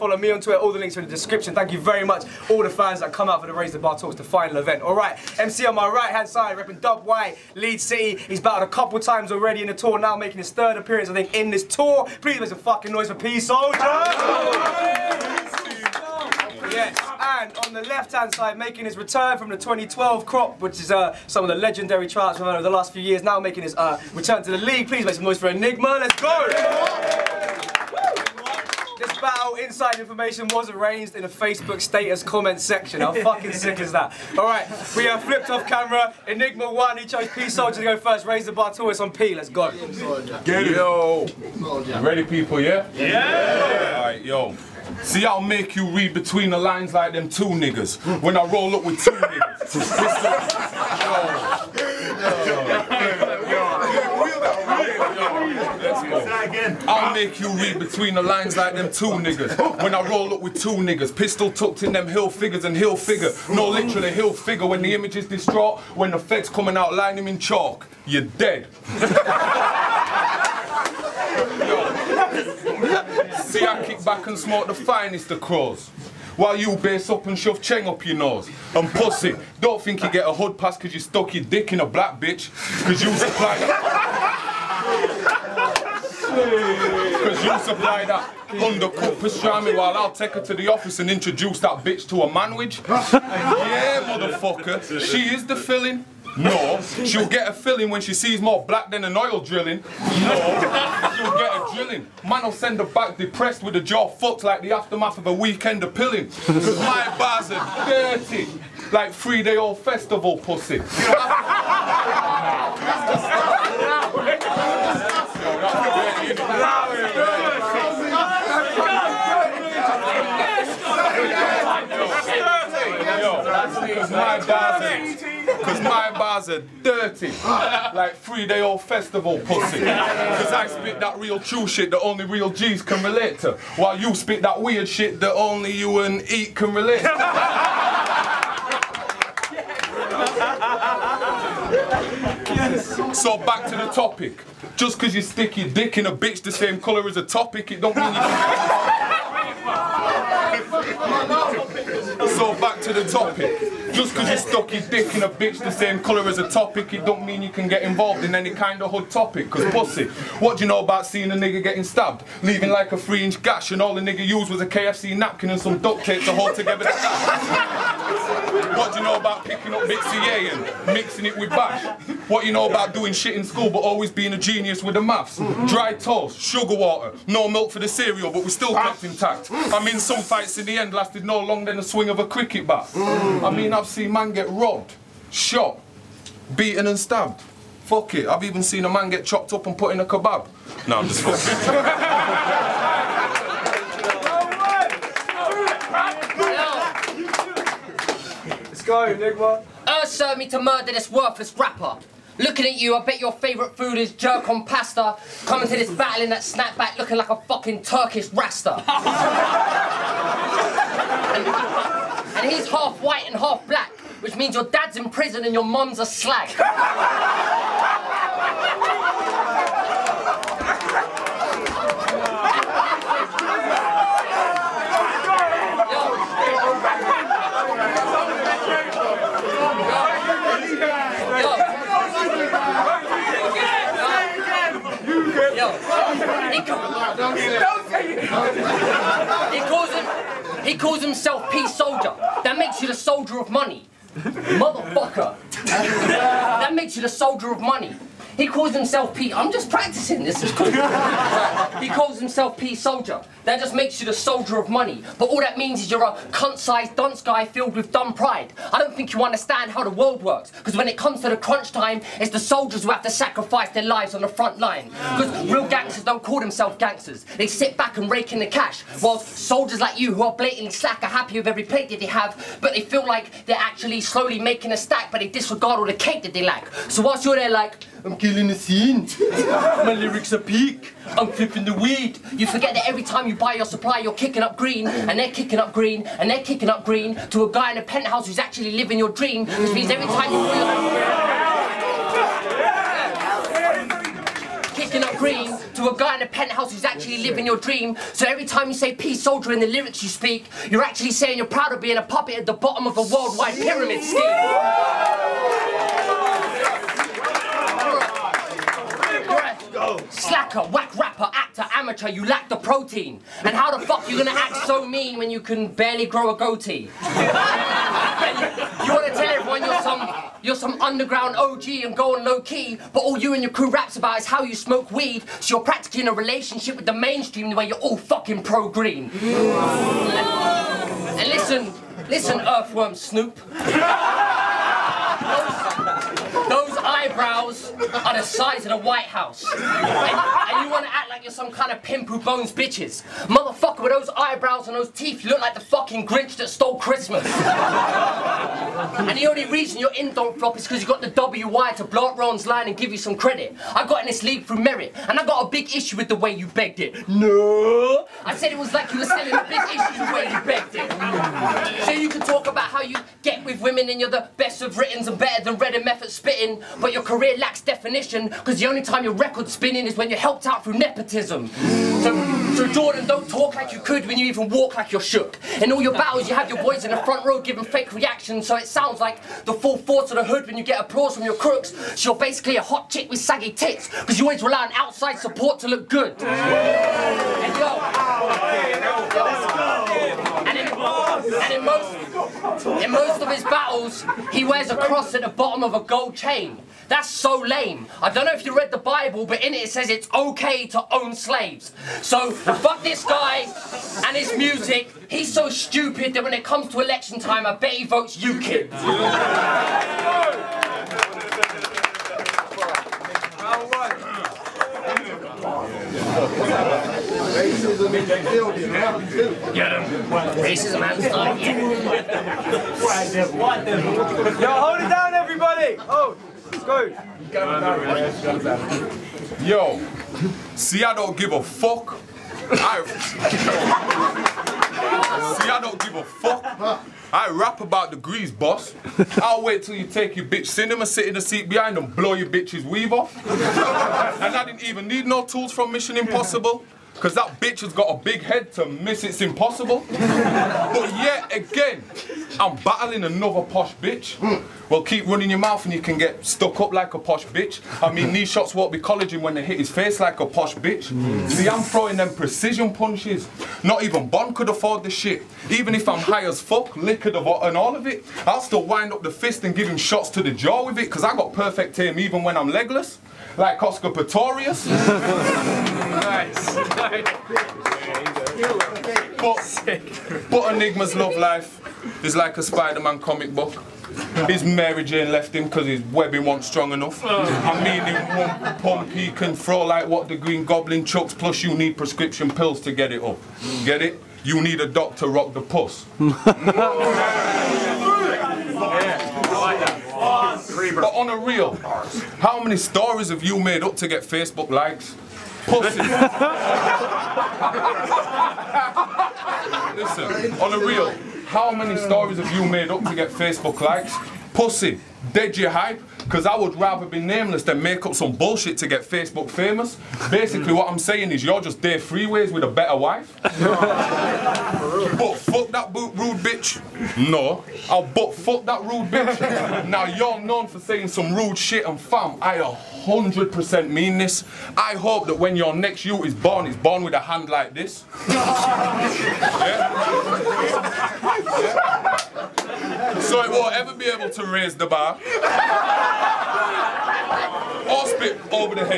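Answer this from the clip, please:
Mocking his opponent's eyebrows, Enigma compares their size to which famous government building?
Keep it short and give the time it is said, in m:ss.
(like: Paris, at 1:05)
The White House, at 5:38.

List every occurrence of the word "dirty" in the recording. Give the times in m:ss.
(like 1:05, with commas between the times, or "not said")
1:47, 2:06.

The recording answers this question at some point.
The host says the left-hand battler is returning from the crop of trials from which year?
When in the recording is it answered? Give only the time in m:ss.
0:19.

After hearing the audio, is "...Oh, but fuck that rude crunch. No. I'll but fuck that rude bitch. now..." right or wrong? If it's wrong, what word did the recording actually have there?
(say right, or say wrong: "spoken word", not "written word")
wrong: "bitch", not "crunch".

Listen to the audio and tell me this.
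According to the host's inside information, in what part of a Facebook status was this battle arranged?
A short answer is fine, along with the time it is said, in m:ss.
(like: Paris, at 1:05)
Comment section, at 0:32.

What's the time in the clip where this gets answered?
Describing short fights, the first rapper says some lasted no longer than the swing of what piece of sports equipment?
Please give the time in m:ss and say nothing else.
3:02.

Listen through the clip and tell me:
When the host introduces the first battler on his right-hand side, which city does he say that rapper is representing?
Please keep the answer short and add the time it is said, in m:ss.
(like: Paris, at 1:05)
Leeds, at 0:07.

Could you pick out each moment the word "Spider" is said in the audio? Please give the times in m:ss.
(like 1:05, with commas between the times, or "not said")
8:02.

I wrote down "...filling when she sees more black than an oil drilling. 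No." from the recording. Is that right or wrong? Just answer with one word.
right.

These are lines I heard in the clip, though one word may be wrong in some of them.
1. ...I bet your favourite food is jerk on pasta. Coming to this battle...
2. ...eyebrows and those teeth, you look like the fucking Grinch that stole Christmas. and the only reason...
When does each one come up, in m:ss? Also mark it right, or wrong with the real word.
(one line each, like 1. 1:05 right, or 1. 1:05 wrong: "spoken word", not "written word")
1. 3:22 right
2. 5:44 right.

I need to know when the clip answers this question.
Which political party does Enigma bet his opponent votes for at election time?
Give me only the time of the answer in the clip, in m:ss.
6:48.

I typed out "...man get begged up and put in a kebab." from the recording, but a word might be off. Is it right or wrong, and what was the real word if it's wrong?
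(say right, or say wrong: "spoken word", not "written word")
wrong: "chopped", not "begged".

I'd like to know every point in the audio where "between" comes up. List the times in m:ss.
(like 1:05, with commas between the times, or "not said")
0:46, 0:57.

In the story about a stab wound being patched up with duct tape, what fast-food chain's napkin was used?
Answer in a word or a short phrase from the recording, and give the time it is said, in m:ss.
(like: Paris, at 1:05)
KFC, at 2:44.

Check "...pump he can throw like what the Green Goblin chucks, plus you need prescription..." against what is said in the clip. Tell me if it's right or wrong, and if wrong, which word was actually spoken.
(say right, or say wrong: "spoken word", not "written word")
right.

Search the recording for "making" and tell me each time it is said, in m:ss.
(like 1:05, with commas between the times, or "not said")
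0:10, 0:18, 0:23, 4:34.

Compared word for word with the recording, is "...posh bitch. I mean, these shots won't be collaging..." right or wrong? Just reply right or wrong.
right.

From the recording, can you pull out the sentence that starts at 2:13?
While you spit that weird shit that only you and Eat can relate yes.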